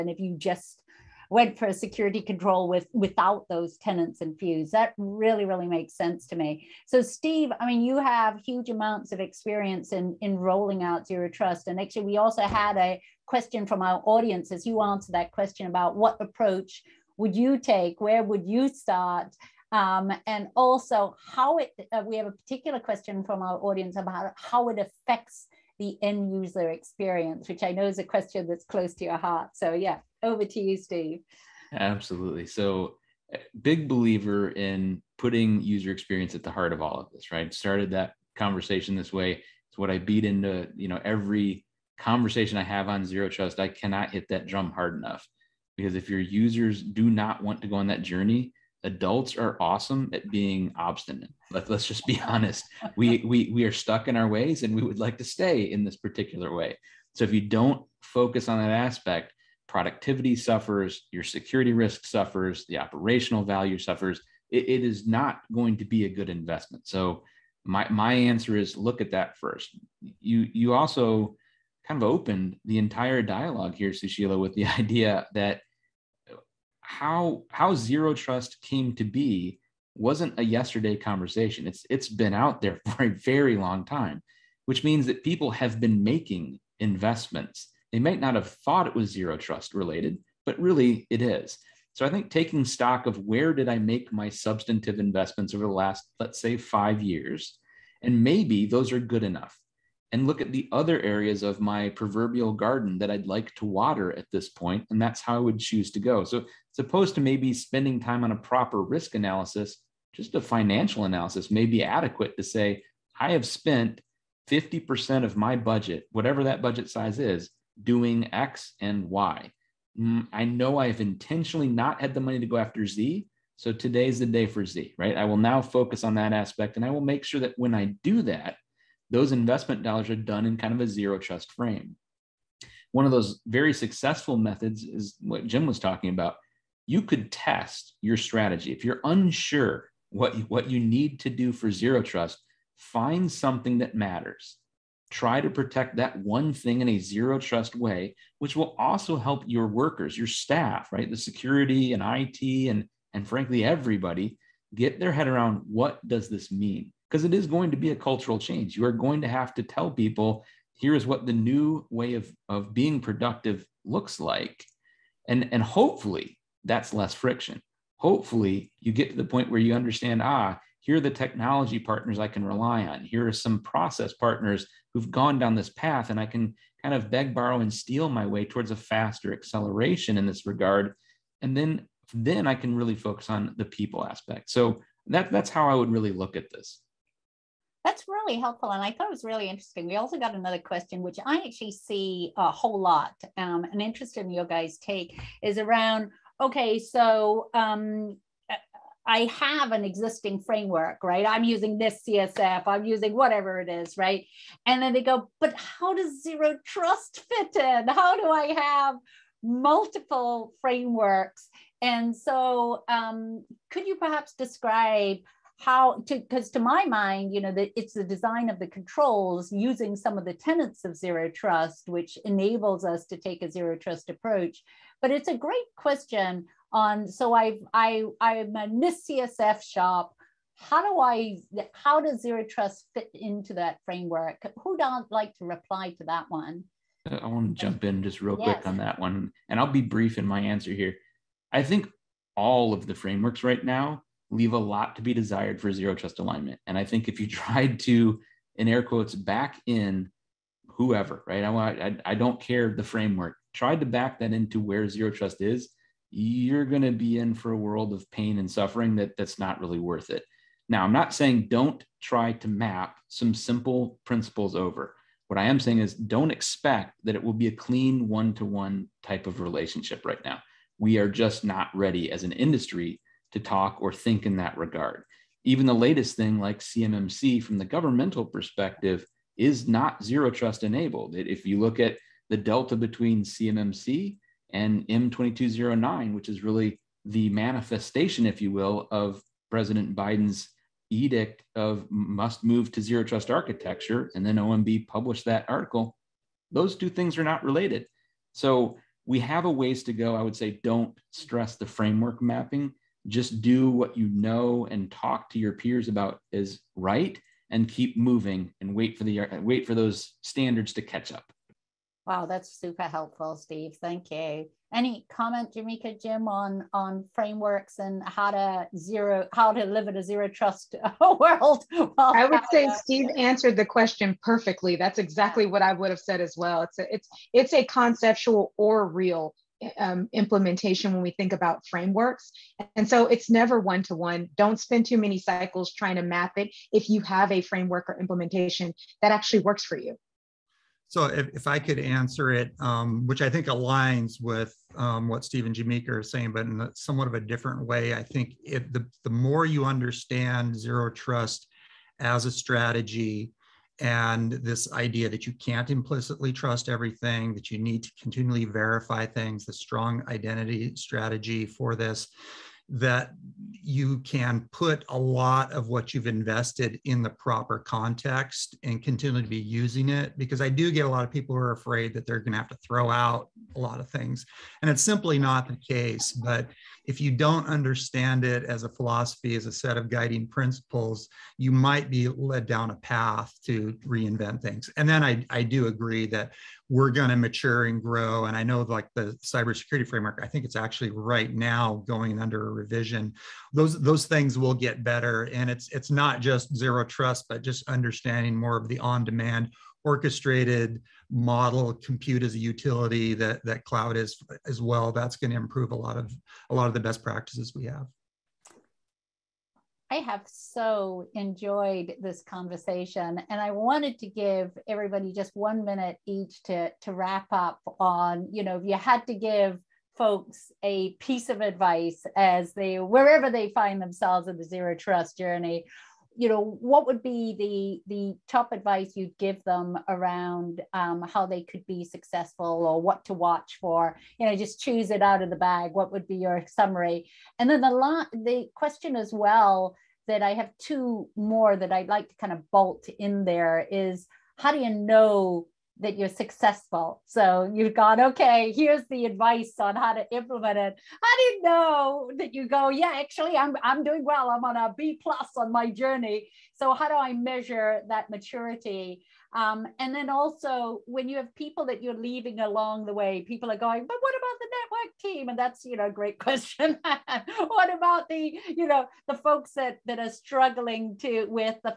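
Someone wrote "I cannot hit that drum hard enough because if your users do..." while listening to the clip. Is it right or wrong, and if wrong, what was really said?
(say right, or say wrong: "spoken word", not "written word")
right.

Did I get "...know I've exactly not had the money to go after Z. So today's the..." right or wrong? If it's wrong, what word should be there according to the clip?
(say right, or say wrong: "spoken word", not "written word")
wrong: "intentionally", not "exactly".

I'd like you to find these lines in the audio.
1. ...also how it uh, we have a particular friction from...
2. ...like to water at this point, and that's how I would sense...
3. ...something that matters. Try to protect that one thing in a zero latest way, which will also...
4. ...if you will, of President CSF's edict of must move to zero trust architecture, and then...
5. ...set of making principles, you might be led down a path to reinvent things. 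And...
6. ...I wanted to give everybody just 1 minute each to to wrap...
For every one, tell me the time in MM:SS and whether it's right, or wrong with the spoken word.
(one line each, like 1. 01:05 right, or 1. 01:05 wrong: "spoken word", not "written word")
1. 00:20 wrong: "question", not "friction"
2. 01:43 wrong: "choose", not "sense"
3. 02:23 wrong: "trust", not "latest"
4. 04:48 wrong: "Biden", not "CSF"
5. 06:19 wrong: "guiding", not "making"
6. 06:53 right.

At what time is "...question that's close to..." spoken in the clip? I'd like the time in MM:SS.
00:28.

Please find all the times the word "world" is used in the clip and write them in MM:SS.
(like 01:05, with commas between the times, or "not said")
04:17, 05:21.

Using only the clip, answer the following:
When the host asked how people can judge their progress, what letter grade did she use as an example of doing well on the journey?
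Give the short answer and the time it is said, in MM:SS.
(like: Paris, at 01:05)
B plus, at 07:34.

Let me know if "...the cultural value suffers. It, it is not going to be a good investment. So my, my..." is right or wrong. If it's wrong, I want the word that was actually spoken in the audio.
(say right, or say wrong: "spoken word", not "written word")
wrong: "operational", not "cultural".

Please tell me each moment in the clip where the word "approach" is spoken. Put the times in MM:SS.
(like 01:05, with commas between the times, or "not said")
00:16, 03:44.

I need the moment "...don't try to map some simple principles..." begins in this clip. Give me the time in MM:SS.
04:21.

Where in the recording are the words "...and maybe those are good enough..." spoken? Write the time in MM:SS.
01:38.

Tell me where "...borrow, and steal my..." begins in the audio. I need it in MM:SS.
02:57.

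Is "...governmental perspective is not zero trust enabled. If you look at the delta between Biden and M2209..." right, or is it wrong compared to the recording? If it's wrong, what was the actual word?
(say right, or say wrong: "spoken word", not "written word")
wrong: "CMMC", not "Biden".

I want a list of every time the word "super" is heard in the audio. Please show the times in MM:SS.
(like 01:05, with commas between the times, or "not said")
05:12.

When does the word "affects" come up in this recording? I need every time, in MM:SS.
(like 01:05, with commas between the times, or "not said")
00:24.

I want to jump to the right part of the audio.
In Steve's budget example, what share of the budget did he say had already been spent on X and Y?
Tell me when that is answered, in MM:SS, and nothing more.
01:54.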